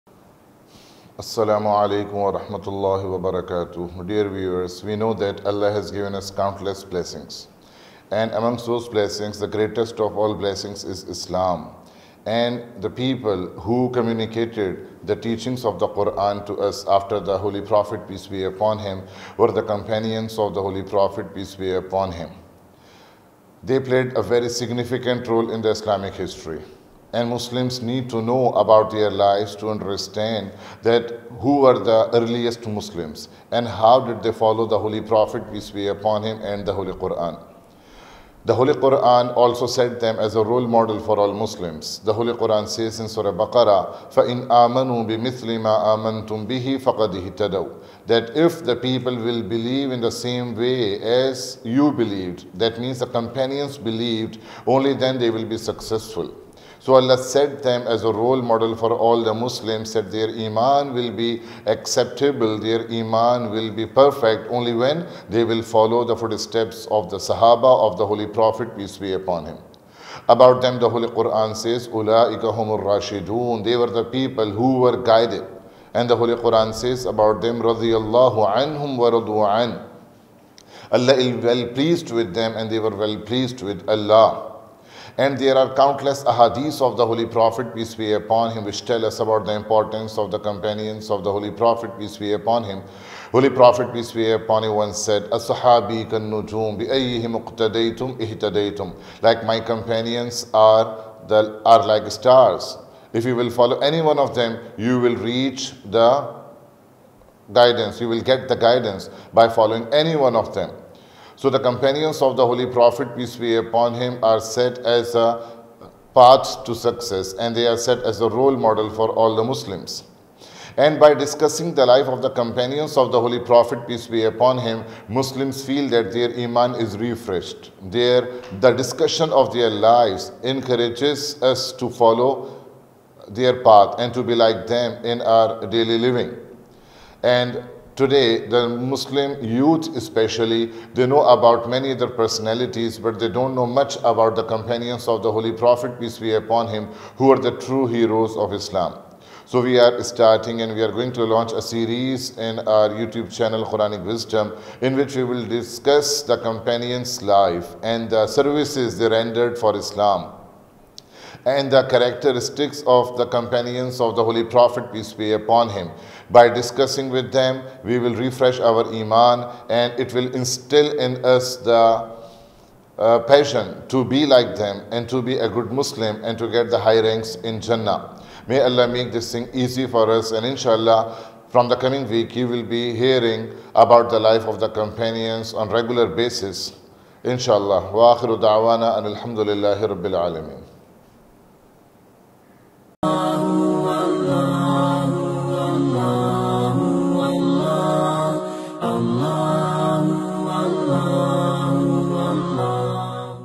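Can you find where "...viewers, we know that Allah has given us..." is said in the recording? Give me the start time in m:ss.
0:04.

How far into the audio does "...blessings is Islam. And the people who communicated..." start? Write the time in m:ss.
0:10.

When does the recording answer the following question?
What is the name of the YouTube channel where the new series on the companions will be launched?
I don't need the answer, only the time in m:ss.
2:33.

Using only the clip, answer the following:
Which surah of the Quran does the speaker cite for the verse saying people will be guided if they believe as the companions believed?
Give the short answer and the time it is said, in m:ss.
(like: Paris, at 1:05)
Surah Baqarah, at 0:43.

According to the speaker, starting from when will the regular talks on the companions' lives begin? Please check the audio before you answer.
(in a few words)
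The coming week.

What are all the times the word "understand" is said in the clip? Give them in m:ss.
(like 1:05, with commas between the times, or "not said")
0:29.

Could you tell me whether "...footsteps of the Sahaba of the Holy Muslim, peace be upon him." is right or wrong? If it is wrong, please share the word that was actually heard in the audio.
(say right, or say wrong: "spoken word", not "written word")
wrong: "Prophet", not "Muslim".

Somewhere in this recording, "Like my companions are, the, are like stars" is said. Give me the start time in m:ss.
1:39.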